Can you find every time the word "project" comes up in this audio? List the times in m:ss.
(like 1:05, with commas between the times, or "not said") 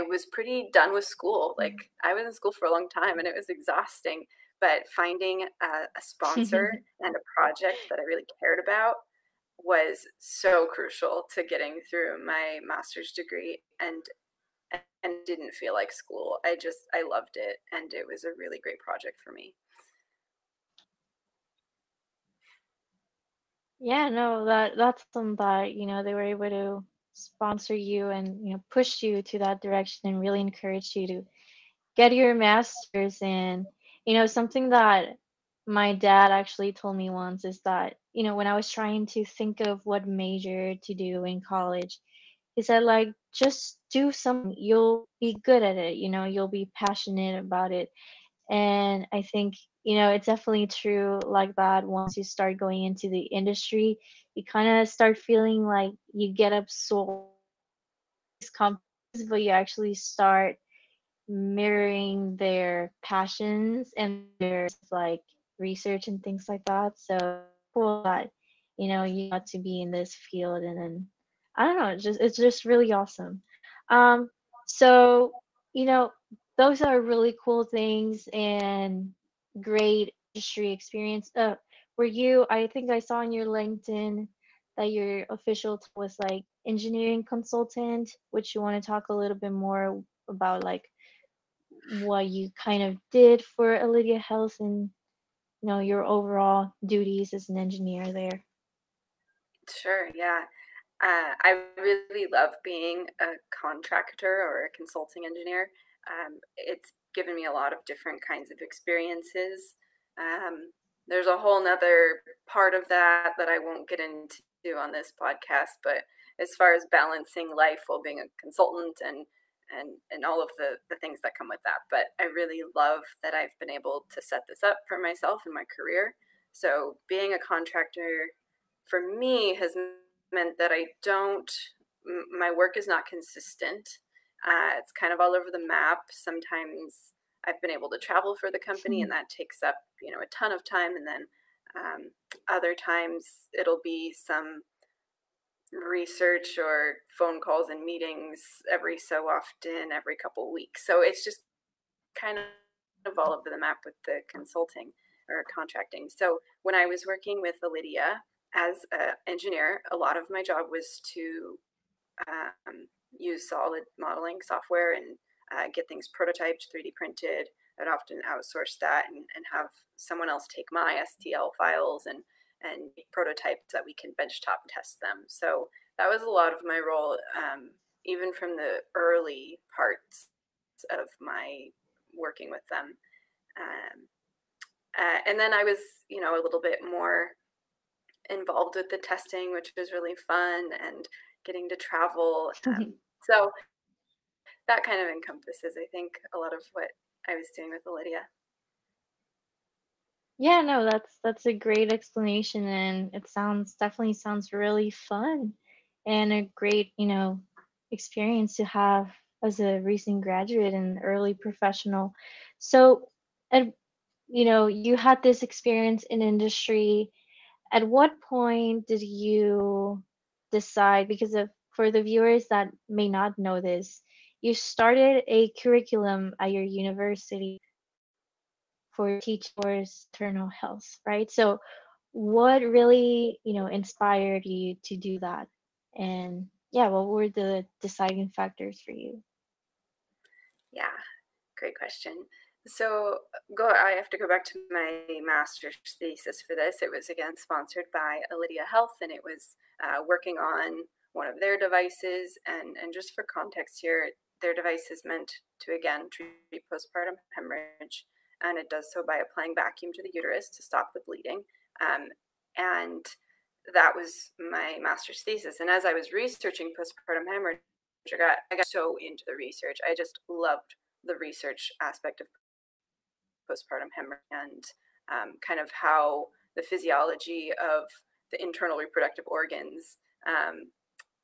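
0:07, 0:18.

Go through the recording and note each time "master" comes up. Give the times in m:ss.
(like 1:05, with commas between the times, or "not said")
0:12, 0:32, 4:05, 4:24.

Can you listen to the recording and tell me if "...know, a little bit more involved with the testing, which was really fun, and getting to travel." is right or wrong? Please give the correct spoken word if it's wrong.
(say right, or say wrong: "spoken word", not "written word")
right.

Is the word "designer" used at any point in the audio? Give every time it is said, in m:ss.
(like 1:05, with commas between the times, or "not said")
not said.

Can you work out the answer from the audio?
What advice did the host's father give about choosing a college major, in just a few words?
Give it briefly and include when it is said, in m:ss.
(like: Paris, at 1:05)
Just do something, at 0:43.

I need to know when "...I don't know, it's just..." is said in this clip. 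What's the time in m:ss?
1:11.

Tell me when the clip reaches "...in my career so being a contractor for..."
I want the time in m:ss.
2:05.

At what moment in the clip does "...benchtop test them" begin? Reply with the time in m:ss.
2:54.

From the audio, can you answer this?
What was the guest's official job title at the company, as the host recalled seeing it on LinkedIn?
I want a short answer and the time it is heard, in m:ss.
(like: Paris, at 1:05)
Engineering consultant, at 1:26.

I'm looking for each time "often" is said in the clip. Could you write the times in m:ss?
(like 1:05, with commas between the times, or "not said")
2:29, 2:47.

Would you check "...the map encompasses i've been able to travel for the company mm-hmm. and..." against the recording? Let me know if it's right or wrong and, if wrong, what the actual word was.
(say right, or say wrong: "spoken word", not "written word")
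wrong: "sometimes", not "encompasses".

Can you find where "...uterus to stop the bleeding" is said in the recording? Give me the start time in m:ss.
4:20.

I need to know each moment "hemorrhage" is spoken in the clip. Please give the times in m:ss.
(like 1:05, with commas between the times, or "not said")
4:17, 4:27, 4:33.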